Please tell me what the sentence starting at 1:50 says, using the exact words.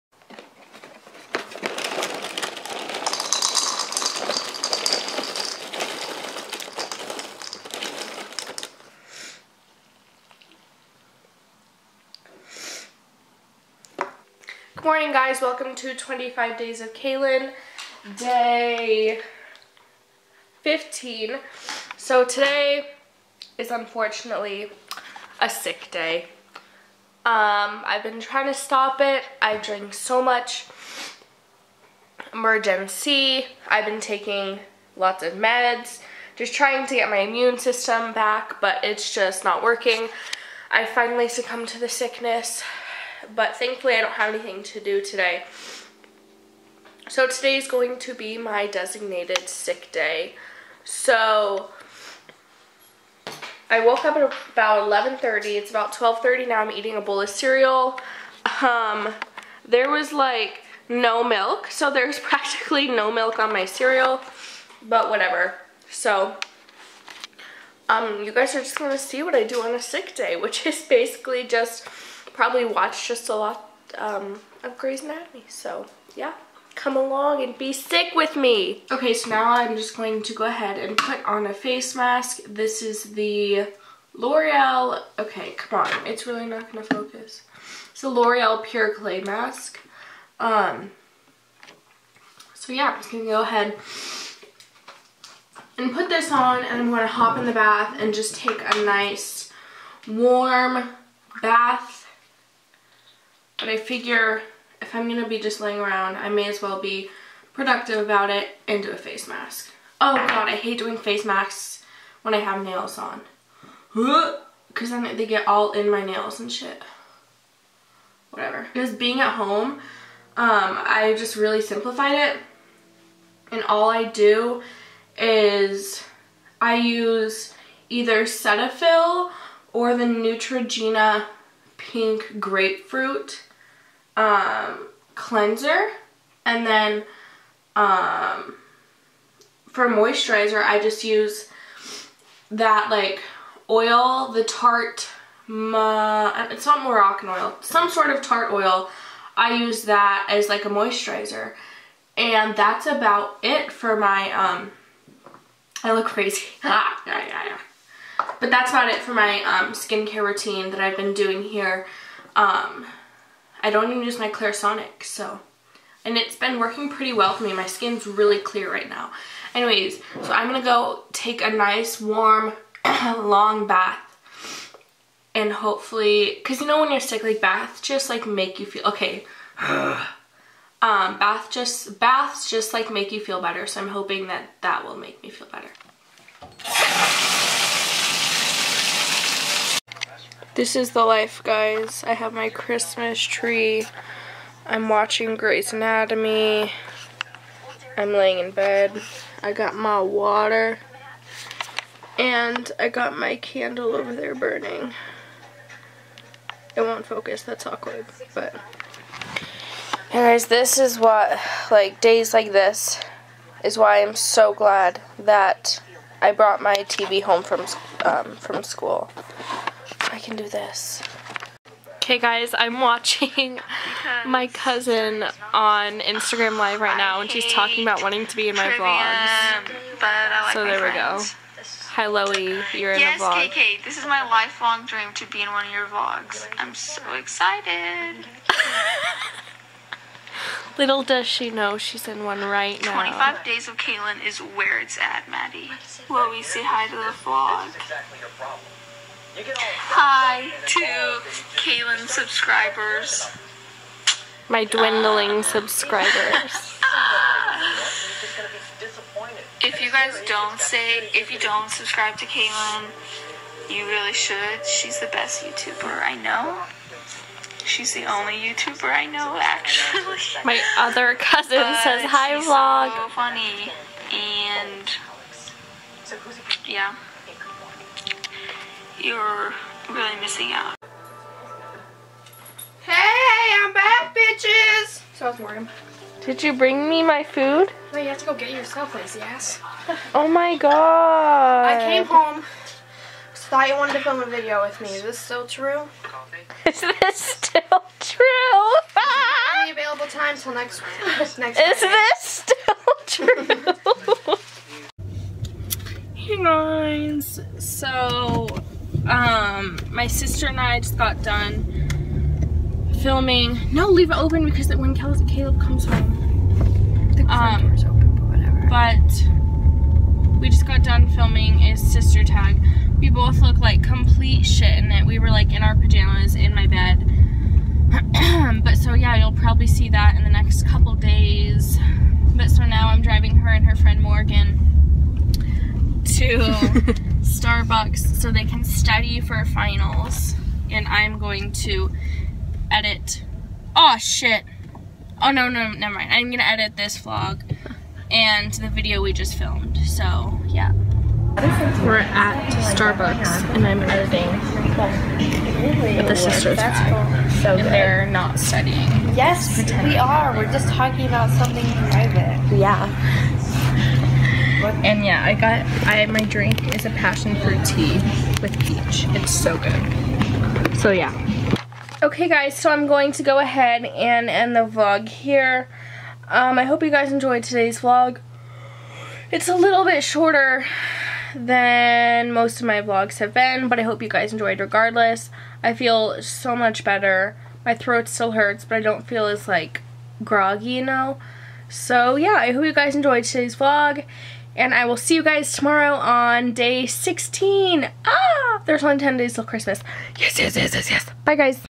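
Oh god, I hate doing face masks when I have nails on.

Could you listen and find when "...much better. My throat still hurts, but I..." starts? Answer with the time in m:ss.
6:26.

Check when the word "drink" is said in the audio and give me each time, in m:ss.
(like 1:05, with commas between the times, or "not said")
0:29, 6:06.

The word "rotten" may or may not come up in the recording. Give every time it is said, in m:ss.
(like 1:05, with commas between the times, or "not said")
not said.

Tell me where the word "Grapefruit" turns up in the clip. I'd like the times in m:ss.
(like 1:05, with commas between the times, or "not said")
2:12.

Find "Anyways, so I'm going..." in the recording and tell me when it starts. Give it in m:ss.
2:49.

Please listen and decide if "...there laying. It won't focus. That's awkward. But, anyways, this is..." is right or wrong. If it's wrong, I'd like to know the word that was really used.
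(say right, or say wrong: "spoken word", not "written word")
wrong: "burning", not "laying".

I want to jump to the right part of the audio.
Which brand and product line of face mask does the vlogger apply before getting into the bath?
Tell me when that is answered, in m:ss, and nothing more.
1:28.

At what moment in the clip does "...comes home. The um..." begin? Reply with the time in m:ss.
5:15.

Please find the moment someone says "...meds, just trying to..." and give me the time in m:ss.
0:35.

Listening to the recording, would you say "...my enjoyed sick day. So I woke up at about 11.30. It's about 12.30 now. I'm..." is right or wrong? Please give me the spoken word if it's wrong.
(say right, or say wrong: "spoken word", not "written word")
wrong: "designated", not "enjoyed".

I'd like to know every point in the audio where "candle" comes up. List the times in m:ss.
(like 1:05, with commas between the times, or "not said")
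3:23.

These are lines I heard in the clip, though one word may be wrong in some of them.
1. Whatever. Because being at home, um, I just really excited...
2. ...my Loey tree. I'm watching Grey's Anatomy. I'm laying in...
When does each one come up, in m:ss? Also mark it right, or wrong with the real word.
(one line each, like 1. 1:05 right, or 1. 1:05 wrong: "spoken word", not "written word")
1. 1:58 wrong: "simplified", not "excited"
2. 3:12 wrong: "Christmas", not "Loey".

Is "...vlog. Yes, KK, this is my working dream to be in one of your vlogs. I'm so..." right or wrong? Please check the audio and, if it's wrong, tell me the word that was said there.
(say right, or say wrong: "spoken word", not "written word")
wrong: "lifelong", not "working".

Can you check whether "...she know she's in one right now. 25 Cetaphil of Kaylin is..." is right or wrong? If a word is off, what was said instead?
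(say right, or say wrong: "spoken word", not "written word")
wrong: "Days", not "Cetaphil".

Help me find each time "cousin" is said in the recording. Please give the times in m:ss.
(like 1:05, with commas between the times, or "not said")
3:44, 4:31.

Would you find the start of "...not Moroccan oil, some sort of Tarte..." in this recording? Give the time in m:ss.
2:26.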